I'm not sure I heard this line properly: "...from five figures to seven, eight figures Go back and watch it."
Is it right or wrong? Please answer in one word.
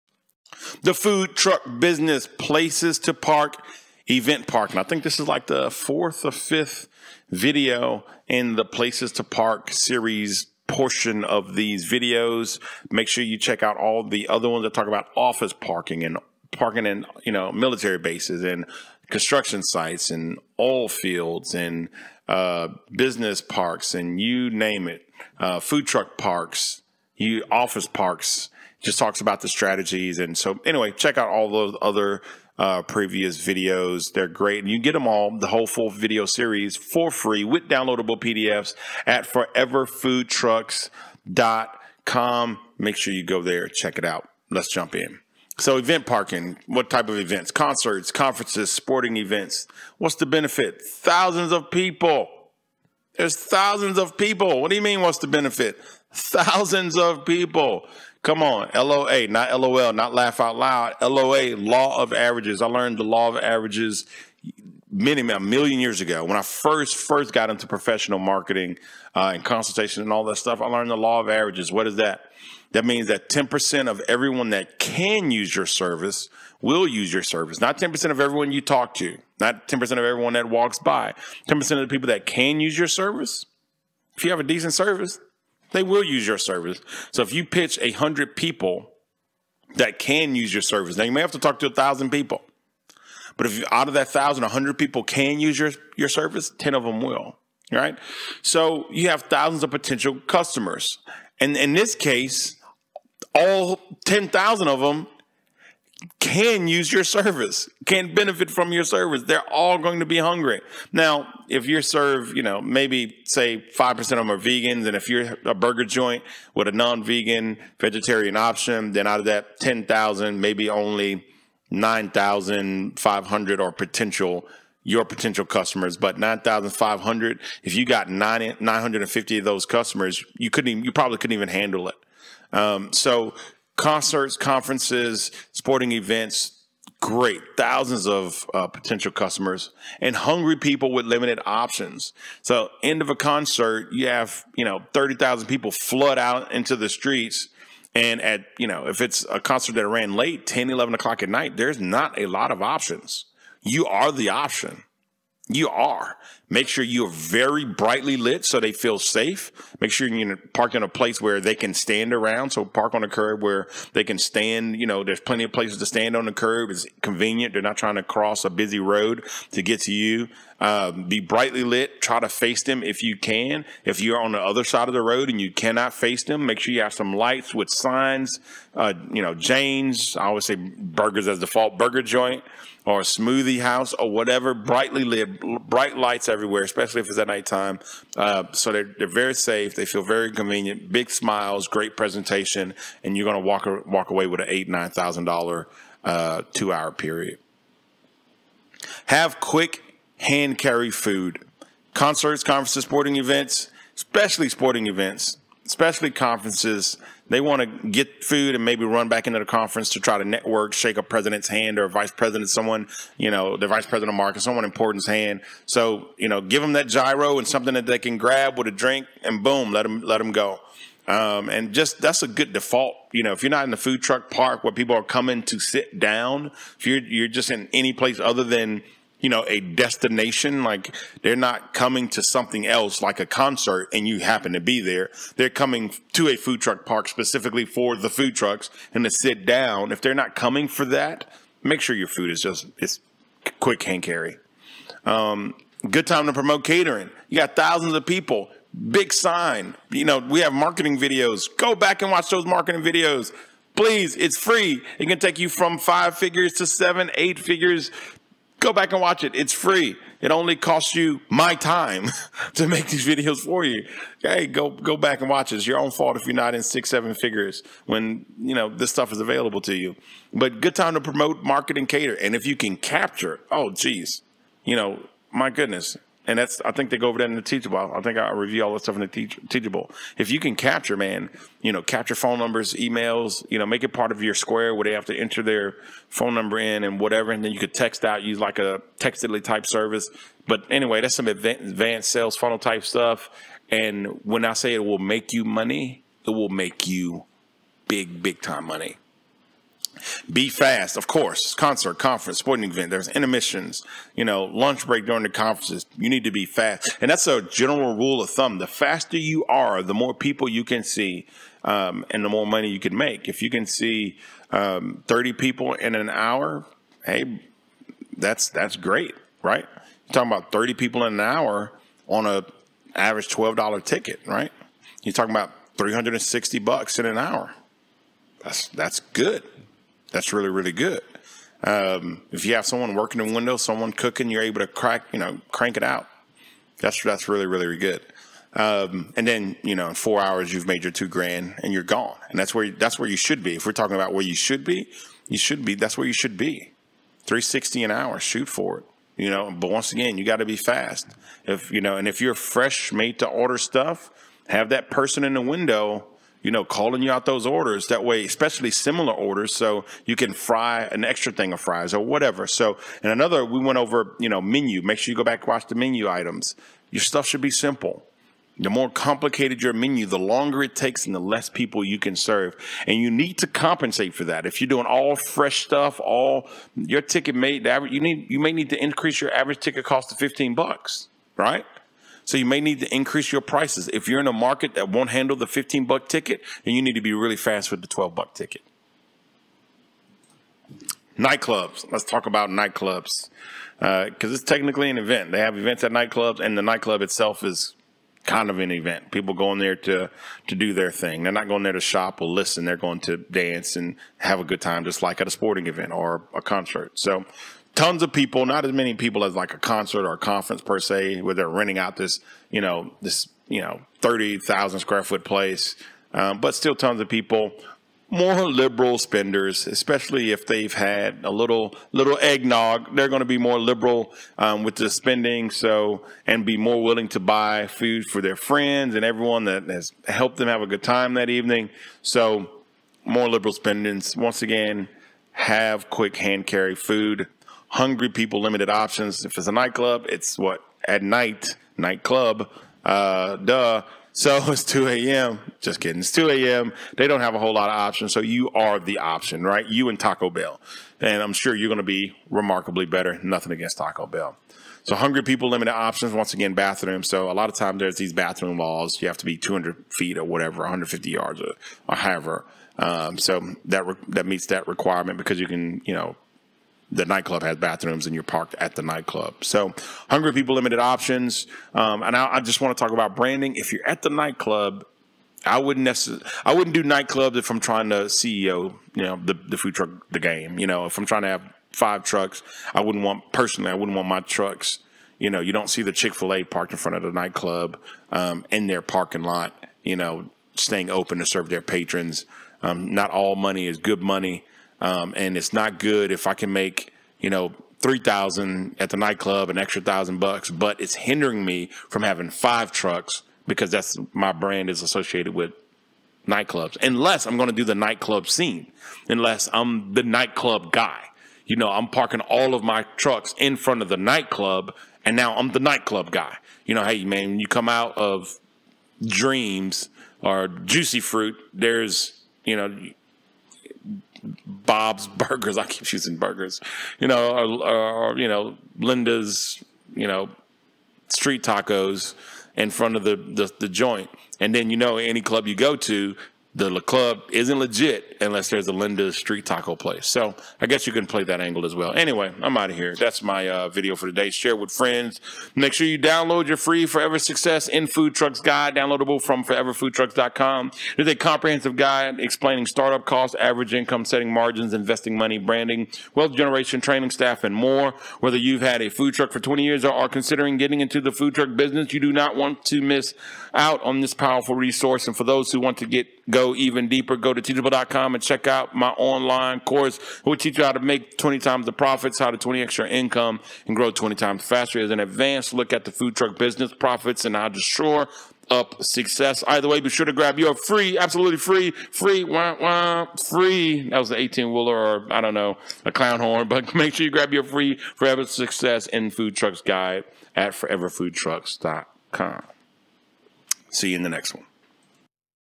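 right.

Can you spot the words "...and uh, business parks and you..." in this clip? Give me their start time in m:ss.
0:21.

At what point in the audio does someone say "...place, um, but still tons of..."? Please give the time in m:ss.
6:55.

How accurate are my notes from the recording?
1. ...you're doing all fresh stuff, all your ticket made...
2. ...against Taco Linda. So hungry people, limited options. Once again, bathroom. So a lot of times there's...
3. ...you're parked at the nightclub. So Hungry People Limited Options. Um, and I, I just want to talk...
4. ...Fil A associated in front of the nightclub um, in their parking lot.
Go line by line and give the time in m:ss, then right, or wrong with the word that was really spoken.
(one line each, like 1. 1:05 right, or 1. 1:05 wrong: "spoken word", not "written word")
1. 6:14 right
2. 7:33 wrong: "Bell", not "Linda"
3. 7:48 right
4. 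8:06 wrong: "parked", not "associated".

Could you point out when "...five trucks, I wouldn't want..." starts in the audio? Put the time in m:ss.
8:01.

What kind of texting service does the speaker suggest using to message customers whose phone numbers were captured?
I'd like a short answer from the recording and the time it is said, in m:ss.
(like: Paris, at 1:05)
Textedly, at 4:48.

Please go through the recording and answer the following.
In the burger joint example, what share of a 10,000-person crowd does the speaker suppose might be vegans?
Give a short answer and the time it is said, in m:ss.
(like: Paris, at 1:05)
5%, at 1:53.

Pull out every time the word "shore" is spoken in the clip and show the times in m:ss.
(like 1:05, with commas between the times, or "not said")
9:37.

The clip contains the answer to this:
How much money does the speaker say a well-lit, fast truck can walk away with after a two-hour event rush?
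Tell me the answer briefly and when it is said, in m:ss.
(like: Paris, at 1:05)
$8,000-9,000, at 3:14.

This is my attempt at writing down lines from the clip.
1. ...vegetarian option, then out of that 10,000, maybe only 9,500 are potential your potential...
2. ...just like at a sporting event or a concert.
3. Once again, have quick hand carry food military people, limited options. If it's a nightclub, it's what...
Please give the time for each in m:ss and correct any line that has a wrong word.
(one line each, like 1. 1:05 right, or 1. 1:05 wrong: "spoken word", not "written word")
1. 1:57 right
2. 6:44 right
3. 7:14 wrong: "hungry", not "military".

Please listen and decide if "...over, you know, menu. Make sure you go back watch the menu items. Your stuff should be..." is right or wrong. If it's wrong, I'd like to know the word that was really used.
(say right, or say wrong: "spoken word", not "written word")
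right.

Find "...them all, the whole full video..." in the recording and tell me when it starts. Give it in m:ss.
0:34.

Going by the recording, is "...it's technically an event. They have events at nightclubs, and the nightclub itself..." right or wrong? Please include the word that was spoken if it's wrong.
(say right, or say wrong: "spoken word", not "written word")
right.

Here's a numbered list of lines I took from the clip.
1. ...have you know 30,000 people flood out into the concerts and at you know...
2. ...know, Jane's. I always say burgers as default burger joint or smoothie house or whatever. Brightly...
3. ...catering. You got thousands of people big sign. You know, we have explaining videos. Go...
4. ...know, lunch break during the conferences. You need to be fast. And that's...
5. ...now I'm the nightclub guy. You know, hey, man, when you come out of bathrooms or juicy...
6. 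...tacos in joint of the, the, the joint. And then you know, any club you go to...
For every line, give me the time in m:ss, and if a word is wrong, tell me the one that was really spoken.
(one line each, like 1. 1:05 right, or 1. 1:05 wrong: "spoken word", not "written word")
1. 2:24 wrong: "streets", not "concerts"
2. 2:59 right
3. 4:06 wrong: "marketing", not "explaining"
4. 5:04 right
5. 8:35 wrong: "dreams", not "bathrooms"
6. 8:51 wrong: "front", not "joint".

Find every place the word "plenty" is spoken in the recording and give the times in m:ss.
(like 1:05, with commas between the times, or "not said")
2:45.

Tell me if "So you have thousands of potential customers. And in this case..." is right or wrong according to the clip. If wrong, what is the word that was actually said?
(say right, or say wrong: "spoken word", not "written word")
right.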